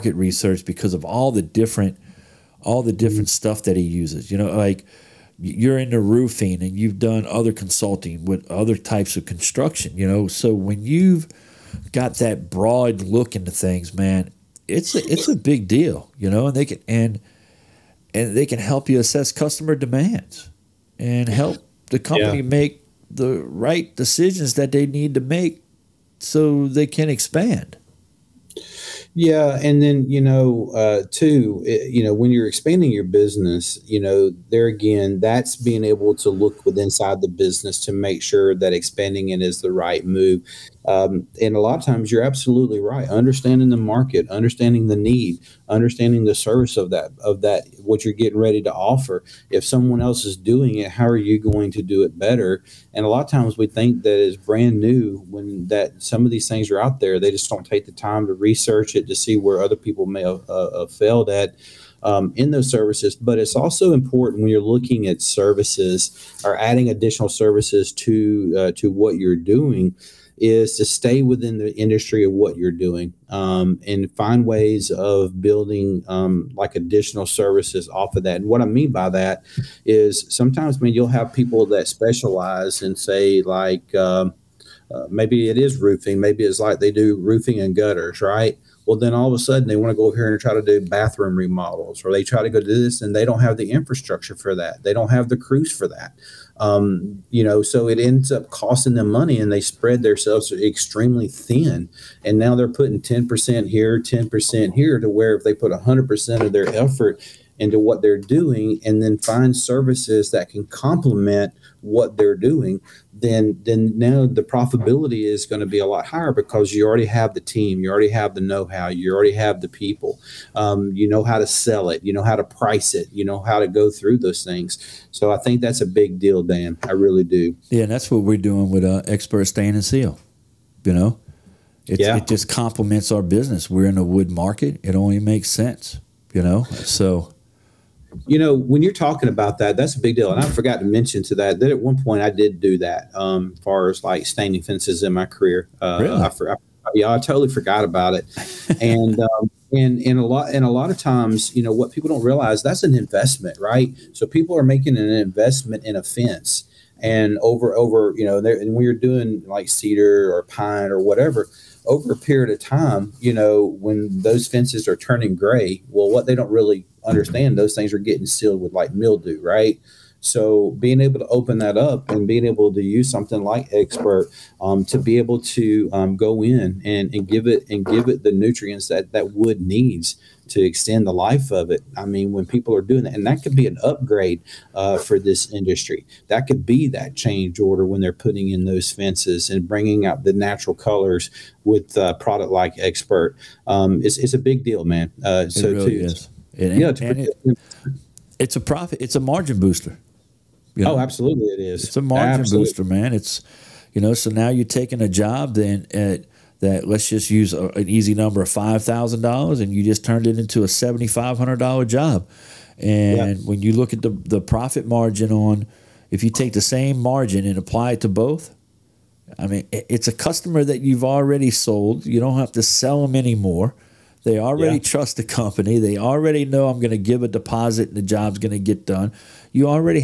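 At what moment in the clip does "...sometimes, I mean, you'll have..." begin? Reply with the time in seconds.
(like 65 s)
80 s.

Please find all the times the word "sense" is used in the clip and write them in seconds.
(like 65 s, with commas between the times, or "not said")
135 s.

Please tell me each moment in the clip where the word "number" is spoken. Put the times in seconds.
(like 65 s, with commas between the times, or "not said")
208 s.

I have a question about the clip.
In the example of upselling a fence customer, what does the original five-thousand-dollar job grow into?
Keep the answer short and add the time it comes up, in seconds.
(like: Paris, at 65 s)
$7,500, at 210 s.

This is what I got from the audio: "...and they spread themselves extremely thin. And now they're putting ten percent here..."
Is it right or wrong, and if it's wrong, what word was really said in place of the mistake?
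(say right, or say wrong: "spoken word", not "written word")
right.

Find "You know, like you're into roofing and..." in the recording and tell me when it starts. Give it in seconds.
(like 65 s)
4 s.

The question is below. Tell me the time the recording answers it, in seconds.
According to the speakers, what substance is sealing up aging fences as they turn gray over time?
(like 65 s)
168 s.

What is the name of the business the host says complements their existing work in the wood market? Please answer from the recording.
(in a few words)
Expert Stain and Seal.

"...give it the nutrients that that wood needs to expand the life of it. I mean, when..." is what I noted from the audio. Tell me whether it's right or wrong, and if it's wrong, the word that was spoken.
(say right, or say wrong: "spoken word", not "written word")
wrong: "extend", not "expand".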